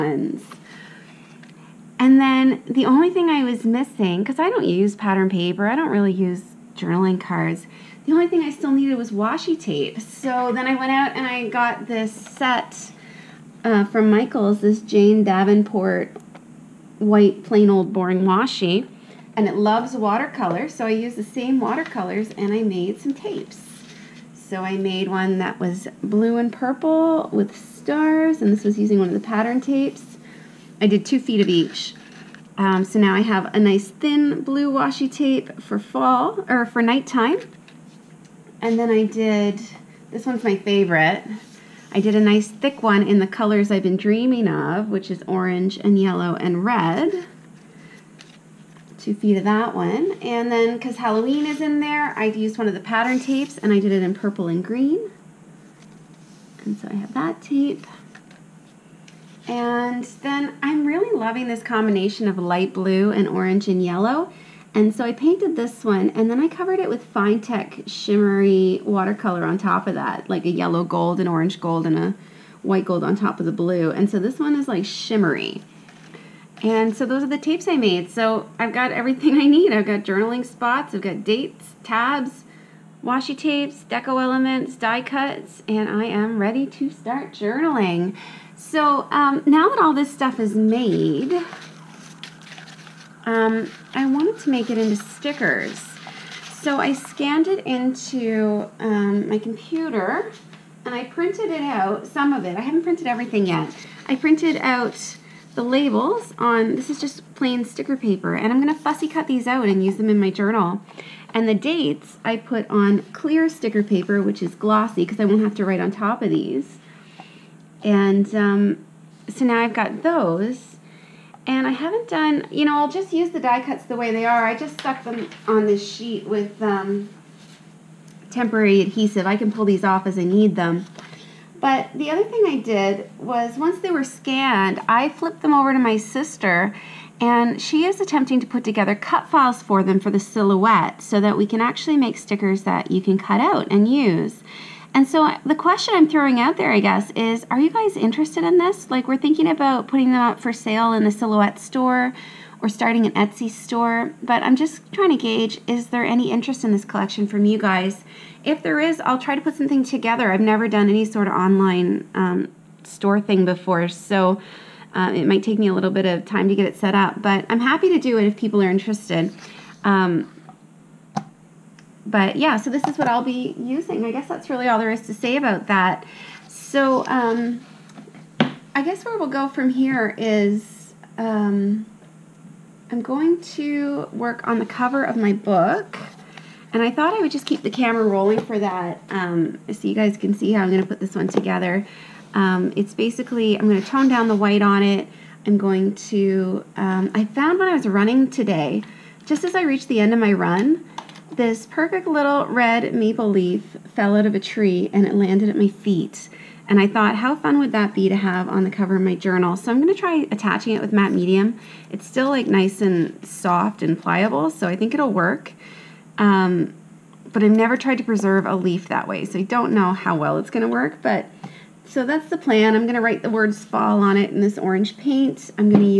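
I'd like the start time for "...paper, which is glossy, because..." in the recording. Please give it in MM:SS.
01:53.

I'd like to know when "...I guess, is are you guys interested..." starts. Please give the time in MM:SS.
02:26.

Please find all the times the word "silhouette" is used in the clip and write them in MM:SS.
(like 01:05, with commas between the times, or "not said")
02:20, 02:31.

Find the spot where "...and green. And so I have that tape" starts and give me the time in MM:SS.
00:54.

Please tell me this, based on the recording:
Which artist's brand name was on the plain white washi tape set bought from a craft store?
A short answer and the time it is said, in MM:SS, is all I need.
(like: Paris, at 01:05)
Jane Davenport, at 00:14.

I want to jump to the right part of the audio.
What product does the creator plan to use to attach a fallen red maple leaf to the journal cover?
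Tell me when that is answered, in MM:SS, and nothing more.
03:30.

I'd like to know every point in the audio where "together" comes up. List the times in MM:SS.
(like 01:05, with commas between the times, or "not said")
02:18, 02:39, 03:11.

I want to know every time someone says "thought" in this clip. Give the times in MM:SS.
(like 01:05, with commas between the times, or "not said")
03:06, 03:26.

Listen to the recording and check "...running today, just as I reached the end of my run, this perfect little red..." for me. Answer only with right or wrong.
right.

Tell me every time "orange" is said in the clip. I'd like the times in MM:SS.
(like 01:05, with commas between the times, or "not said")
00:45, 01:03, 01:11, 03:44.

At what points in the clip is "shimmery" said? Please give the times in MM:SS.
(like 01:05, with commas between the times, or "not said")
01:07, 01:14.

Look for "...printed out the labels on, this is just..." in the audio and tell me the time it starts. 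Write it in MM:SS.
01:44.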